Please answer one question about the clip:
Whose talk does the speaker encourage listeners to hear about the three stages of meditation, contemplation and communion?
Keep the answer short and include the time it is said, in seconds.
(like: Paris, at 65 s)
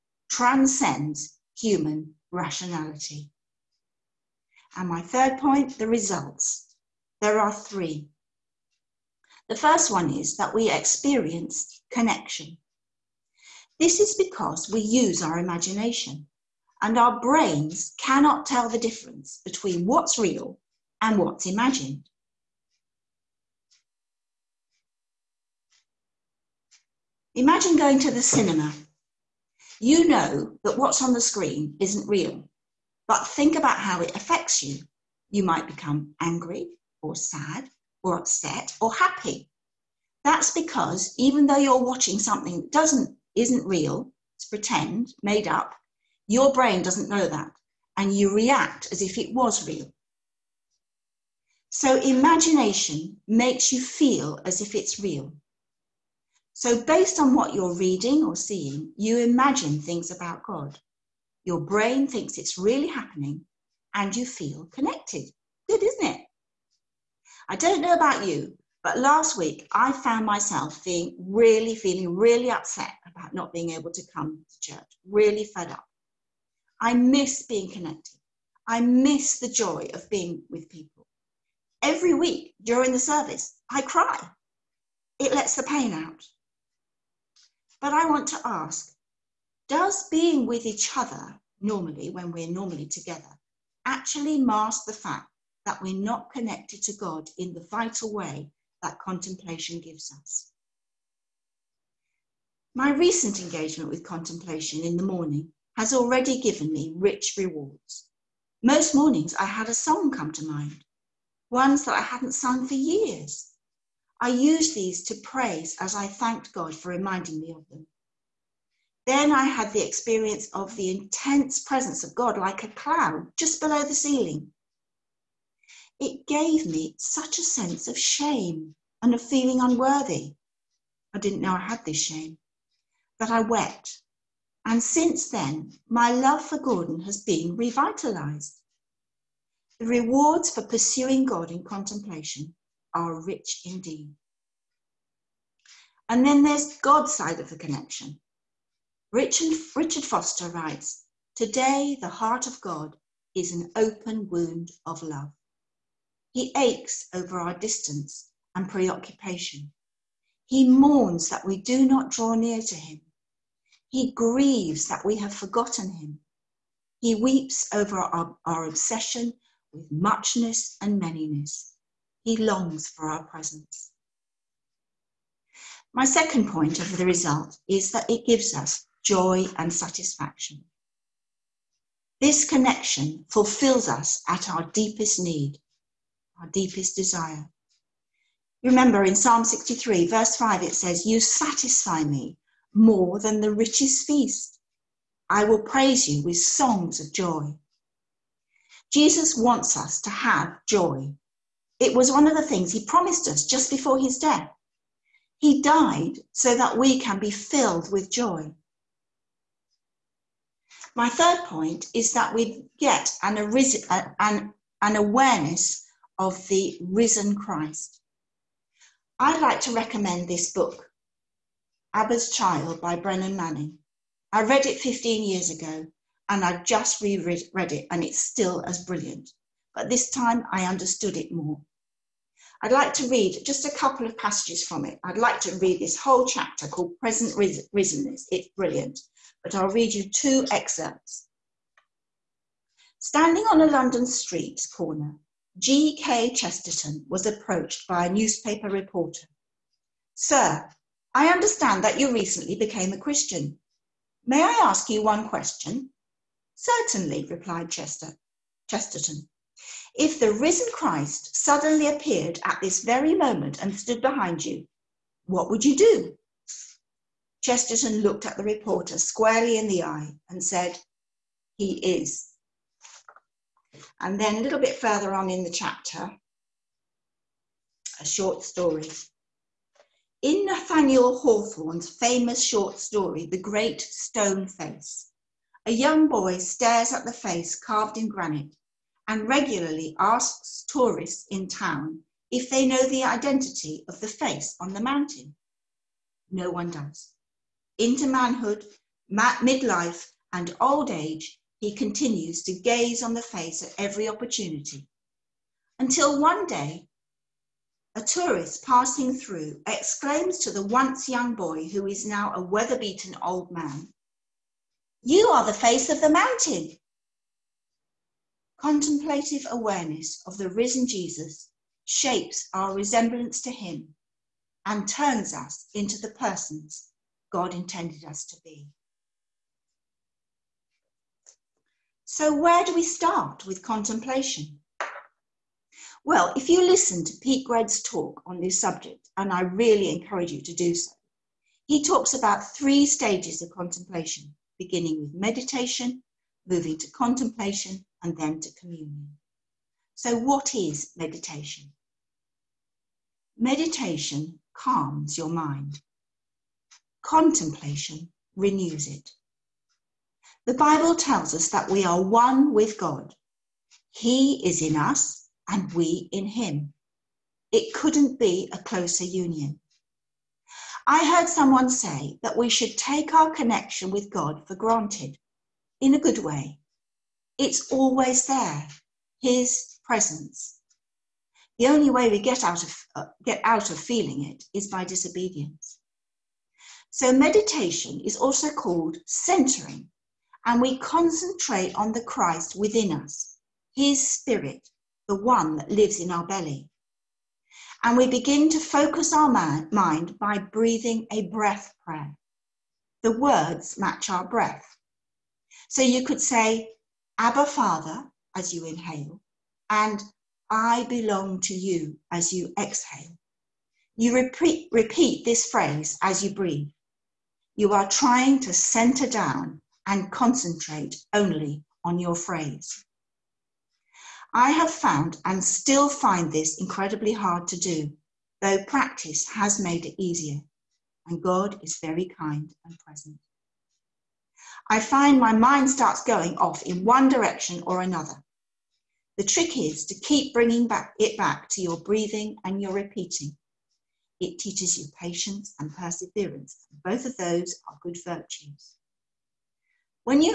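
Pete Greig, at 337 s.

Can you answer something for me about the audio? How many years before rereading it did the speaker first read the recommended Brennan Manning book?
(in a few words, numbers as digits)
15.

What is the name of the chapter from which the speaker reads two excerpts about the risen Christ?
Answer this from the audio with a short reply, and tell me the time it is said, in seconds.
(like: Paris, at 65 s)
Present Risenness, at 236 s.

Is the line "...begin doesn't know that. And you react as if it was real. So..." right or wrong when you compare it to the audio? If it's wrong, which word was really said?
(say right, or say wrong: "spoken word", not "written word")
wrong: "brain", not "begin".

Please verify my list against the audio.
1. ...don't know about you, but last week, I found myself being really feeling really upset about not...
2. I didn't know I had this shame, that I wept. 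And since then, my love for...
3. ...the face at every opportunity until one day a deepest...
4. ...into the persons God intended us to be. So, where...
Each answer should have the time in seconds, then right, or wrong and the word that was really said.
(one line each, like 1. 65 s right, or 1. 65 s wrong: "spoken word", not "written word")
1. 67 s right
2. 131 s right
3. 303 s wrong: "tourist", not "deepest"
4. 325 s right.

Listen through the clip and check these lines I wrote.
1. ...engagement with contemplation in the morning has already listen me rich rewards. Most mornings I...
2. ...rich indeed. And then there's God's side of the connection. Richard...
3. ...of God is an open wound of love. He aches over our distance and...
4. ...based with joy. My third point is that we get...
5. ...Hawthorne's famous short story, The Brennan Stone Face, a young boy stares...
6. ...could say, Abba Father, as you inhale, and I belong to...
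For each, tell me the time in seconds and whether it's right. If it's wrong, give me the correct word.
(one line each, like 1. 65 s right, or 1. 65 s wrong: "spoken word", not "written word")
1. 103 s wrong: "given", not "listen"
2. 143 s right
3. 152 s right
4. 207 s wrong: "filled", not "based"
5. 281 s wrong: "Great", not "Brennan"
6. 406 s right.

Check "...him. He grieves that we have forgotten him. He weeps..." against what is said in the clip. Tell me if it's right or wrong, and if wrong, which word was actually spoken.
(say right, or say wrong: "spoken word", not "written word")
right.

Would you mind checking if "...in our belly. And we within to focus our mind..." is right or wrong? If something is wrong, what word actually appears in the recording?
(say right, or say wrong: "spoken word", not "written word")
wrong: "begin", not "within".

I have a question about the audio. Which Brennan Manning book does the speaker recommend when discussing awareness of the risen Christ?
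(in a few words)
Abba's Child.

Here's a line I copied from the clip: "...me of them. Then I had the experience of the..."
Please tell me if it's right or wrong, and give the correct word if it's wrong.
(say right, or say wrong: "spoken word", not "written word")
right.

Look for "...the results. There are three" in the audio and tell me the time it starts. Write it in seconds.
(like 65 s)
5 s.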